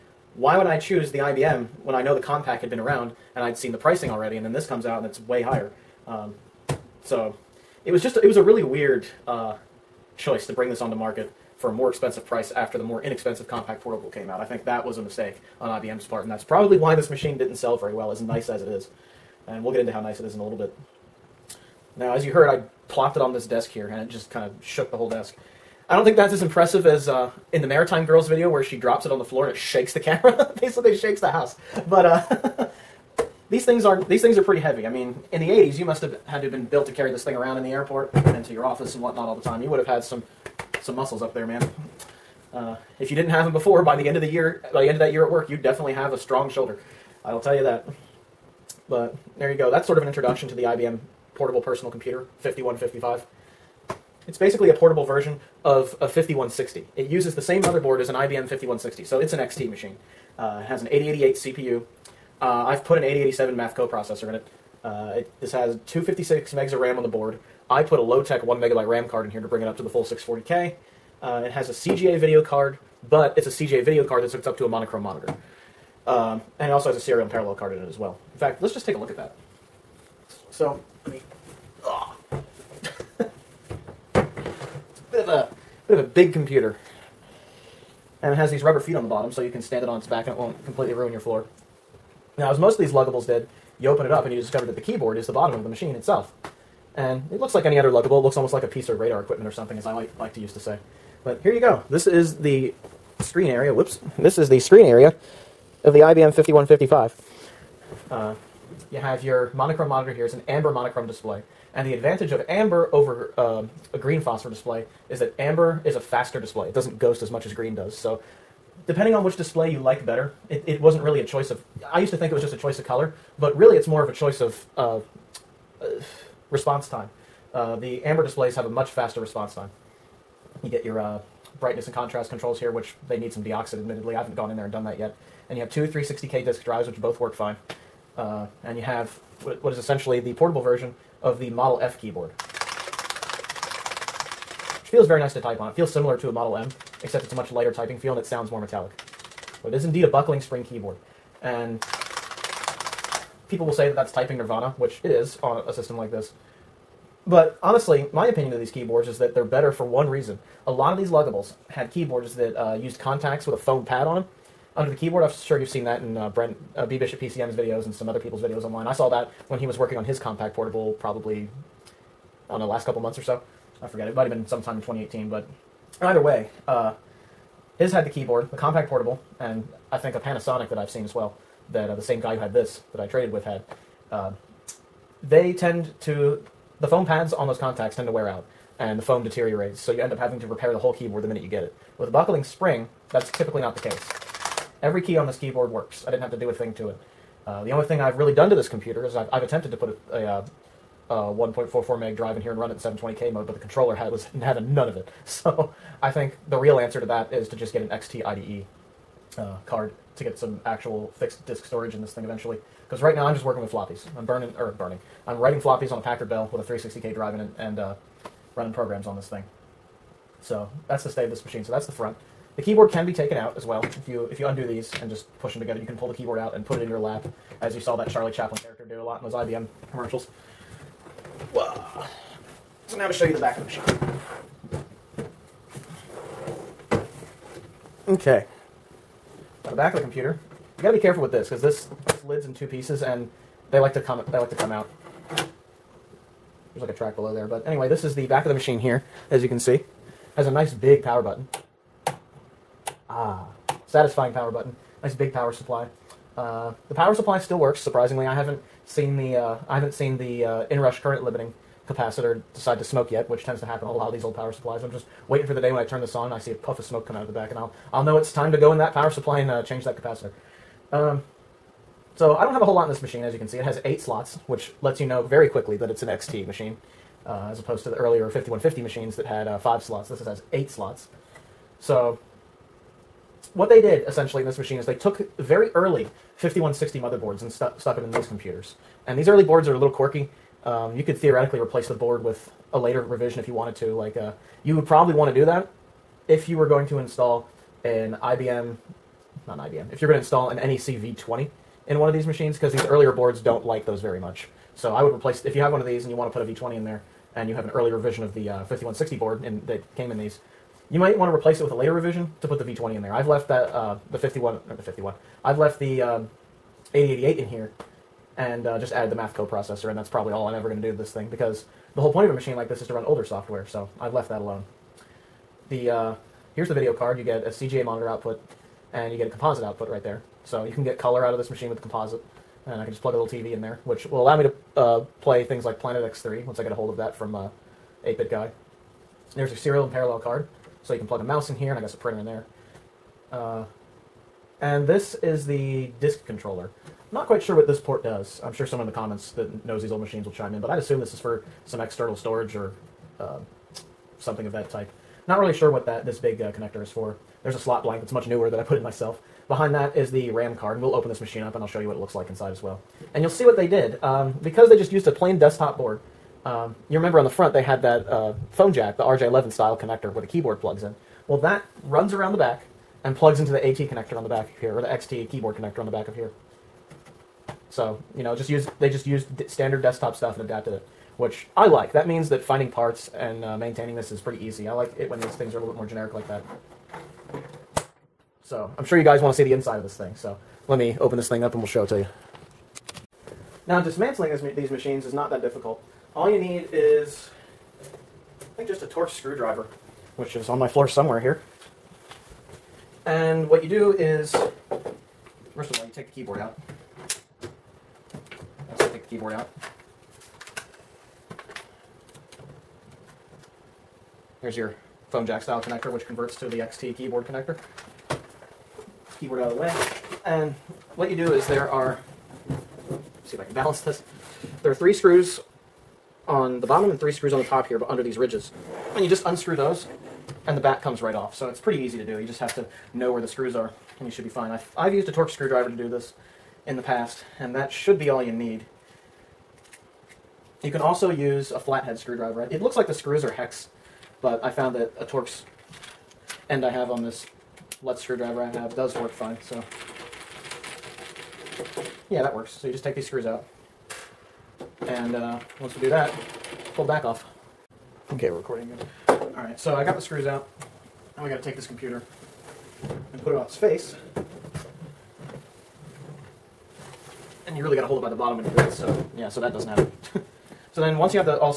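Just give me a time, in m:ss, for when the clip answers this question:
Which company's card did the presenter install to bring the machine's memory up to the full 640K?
1:08.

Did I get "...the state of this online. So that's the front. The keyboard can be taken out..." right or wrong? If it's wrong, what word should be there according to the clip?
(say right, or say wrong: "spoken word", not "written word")
wrong: "machine", not "online".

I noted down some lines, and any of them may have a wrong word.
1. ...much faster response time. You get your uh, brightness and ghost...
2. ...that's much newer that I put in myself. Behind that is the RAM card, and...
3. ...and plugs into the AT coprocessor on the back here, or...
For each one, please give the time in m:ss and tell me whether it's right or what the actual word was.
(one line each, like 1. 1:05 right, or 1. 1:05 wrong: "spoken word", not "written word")
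1. 2:08 wrong: "contrast", not "ghost"
2. 5:58 right
3. 6:13 wrong: "connector", not "coprocessor".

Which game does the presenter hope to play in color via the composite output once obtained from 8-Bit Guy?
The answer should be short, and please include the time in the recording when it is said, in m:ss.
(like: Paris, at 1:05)
Planet X3, at 5:35.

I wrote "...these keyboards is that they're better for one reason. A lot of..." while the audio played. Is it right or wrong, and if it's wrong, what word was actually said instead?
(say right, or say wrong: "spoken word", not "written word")
right.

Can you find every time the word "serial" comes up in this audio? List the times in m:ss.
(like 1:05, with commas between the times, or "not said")
1:16, 5:39.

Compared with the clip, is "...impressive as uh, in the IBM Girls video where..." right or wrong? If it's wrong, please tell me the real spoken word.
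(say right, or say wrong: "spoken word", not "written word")
wrong: "Maritime", not "IBM".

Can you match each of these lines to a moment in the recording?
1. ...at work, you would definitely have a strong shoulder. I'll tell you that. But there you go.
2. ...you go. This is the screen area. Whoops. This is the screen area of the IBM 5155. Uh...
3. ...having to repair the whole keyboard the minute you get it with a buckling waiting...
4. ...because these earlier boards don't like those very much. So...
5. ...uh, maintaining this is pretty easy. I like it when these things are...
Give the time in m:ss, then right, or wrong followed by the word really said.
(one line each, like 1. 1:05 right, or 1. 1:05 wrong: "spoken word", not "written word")
1. 0:45 right
2. 1:41 right
3. 3:10 wrong: "spring", not "waiting"
4. 5:02 right
5. 6:23 right.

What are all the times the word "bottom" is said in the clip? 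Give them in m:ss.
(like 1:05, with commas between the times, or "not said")
1:29, 1:35, 7:06, 7:48.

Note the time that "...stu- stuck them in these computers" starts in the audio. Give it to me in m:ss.
4:47.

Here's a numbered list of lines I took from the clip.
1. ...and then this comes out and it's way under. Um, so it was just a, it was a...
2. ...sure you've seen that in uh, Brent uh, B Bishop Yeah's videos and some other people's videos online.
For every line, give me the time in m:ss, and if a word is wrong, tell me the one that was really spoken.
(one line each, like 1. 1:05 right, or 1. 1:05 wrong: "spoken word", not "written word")
1. 0:04 wrong: "higher", not "under"
2. 2:45 wrong: "PCM", not "Yeah".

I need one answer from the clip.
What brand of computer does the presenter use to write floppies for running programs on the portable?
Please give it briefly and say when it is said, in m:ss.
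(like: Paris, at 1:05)
Packard Bell, at 3:36.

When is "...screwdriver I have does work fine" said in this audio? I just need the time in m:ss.
7:28.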